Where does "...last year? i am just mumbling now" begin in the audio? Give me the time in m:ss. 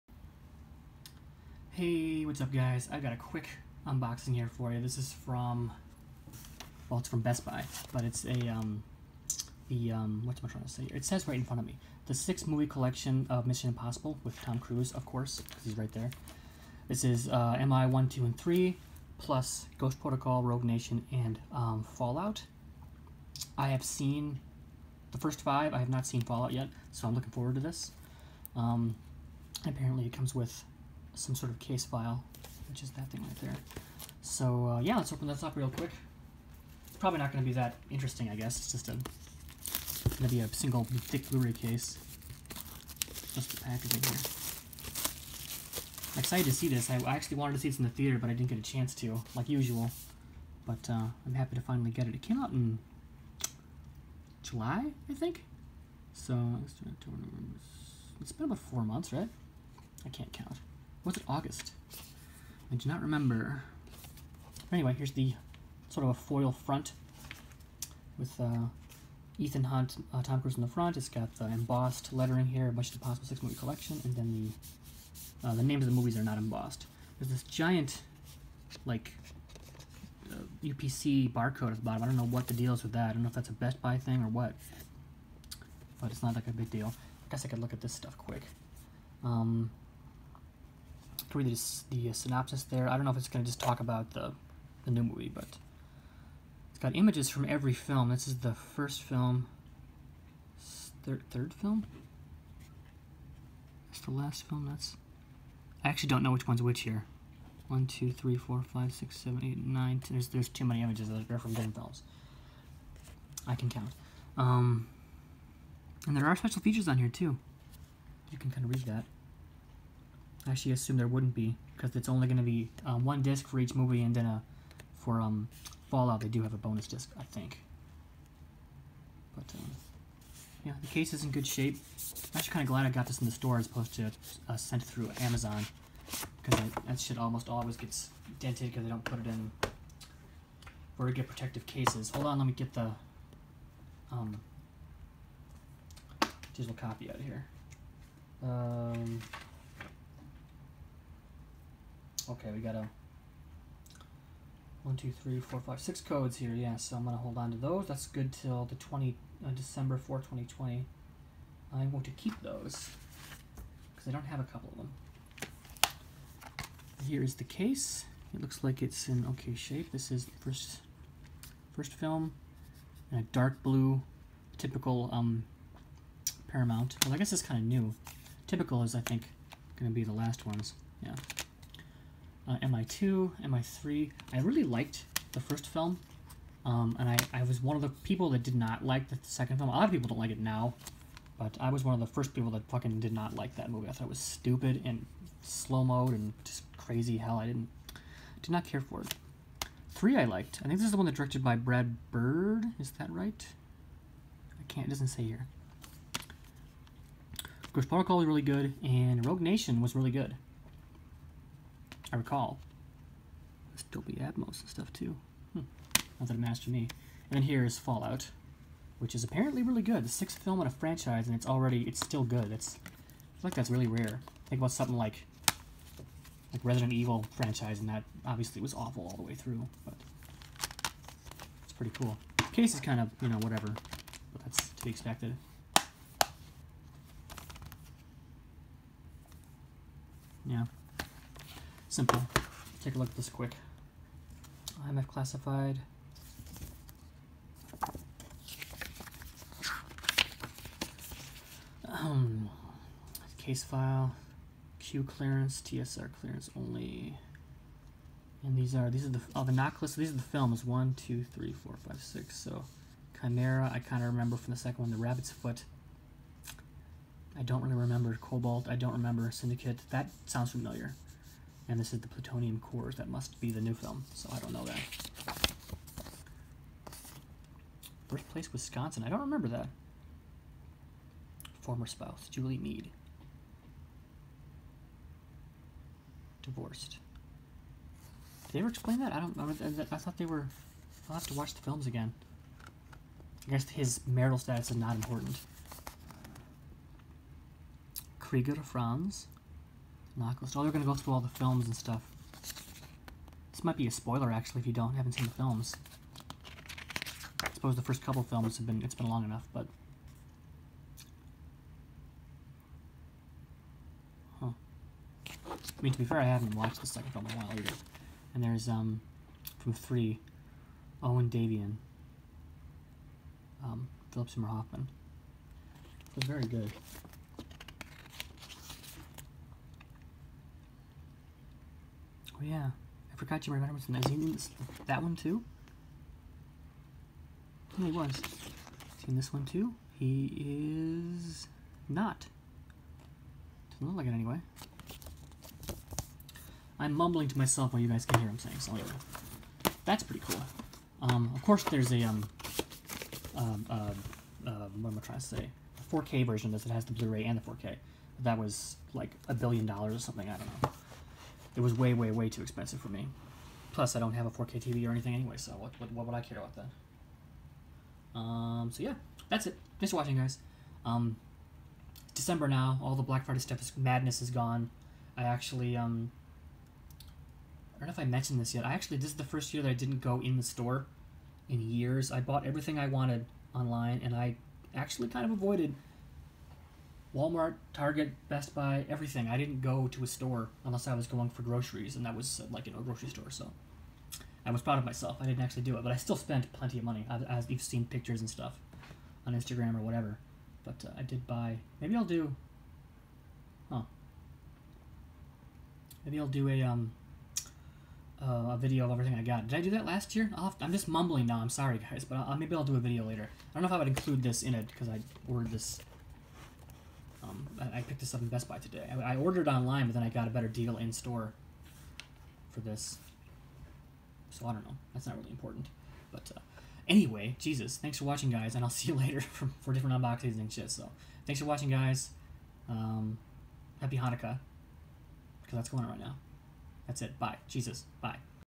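6:49.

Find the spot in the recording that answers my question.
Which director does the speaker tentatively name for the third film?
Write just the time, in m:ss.
3:21.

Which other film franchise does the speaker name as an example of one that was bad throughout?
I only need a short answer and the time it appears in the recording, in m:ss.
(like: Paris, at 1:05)
Resident Evil, at 3:46.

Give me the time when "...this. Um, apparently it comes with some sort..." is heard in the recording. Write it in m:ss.
0:27.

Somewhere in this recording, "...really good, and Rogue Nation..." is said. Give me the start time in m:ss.
3:28.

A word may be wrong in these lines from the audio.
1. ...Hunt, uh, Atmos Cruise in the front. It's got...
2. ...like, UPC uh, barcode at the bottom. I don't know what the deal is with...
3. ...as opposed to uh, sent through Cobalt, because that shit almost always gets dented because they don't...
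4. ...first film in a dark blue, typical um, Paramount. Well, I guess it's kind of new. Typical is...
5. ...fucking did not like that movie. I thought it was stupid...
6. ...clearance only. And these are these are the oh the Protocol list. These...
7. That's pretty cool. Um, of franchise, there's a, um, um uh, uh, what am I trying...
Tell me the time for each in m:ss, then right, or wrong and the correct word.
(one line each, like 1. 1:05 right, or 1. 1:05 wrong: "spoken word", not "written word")
1. 1:09 wrong: "Tom", not "Atmos"
2. 1:18 right
3. 2:13 wrong: "Amazon", not "Cobalt"
4. 2:51 right
5. 3:12 right
6. 4:16 wrong: "NOC", not "Protocol"
7. 5:49 wrong: "course", not "franchise".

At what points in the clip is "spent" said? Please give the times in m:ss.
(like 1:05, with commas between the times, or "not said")
6:36.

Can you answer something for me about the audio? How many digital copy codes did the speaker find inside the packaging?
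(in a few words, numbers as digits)
6.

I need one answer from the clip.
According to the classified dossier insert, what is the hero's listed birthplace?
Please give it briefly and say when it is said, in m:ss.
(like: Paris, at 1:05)
Wisconsin, at 4:38.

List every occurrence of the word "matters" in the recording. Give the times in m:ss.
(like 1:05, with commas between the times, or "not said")
3:36.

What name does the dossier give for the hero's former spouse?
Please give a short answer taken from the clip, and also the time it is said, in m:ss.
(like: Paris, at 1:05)
Julie Meade, at 4:42.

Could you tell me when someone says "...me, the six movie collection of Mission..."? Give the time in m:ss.
0:11.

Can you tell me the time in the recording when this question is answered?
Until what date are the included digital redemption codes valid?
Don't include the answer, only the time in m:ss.
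2:39.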